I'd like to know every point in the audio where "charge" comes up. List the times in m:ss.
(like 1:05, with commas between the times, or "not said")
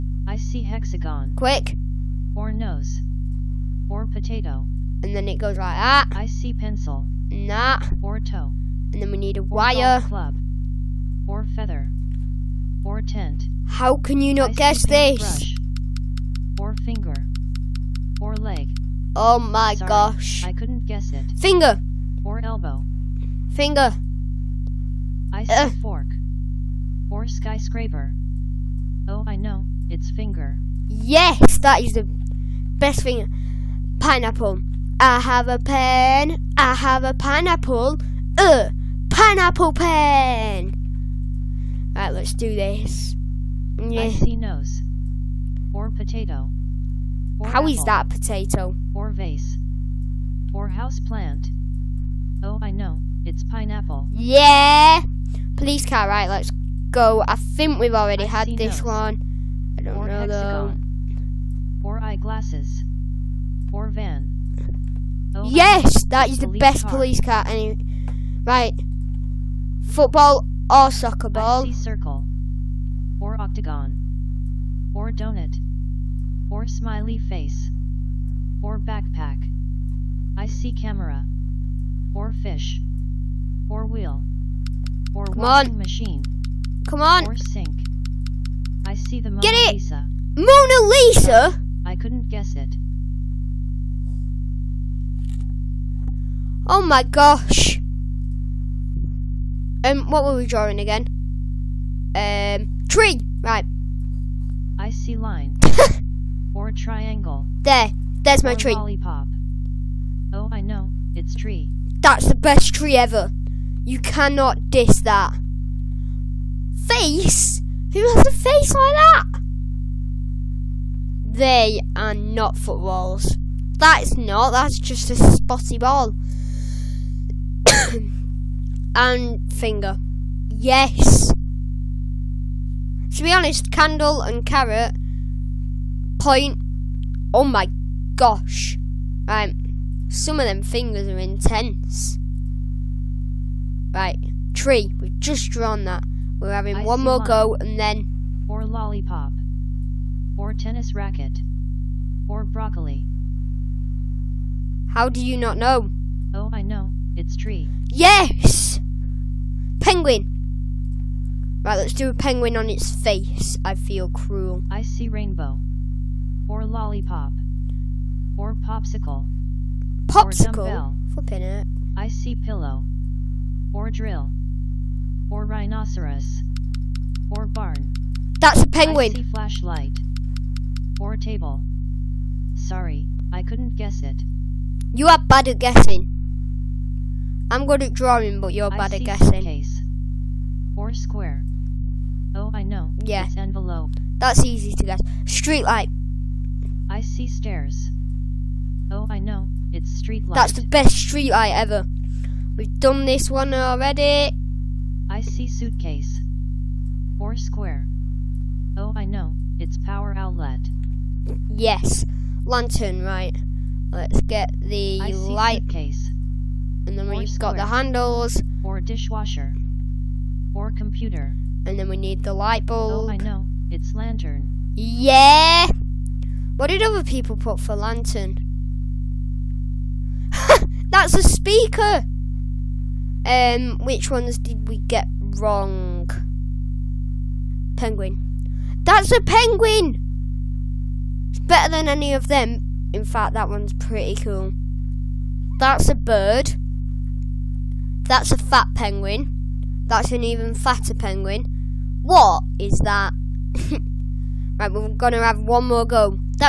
not said.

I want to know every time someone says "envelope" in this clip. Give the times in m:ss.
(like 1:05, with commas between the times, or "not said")
3:13.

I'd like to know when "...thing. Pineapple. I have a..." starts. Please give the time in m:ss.
0:33.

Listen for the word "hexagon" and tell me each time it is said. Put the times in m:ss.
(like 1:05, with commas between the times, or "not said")
0:00, 1:00.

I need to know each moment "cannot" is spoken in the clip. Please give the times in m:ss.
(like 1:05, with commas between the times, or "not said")
1:53.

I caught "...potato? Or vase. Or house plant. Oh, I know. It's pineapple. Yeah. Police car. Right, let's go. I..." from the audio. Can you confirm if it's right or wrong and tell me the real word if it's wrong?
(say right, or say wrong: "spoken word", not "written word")
right.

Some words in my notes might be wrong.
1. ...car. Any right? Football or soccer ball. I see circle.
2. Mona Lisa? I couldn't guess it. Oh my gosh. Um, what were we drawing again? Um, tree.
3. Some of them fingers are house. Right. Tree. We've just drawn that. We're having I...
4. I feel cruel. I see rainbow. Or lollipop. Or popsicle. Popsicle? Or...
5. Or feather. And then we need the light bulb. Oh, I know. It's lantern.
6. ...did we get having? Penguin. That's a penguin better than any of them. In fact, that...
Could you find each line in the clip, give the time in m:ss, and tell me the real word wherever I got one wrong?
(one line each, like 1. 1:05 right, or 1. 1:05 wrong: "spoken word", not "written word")
1. 1:07 right
2. 1:30 right
3. 2:20 wrong: "intense", not "house"
4. 2:43 right
5. 3:40 wrong: "computer", not "feather"
6. 3:54 wrong: "wrong", not "having".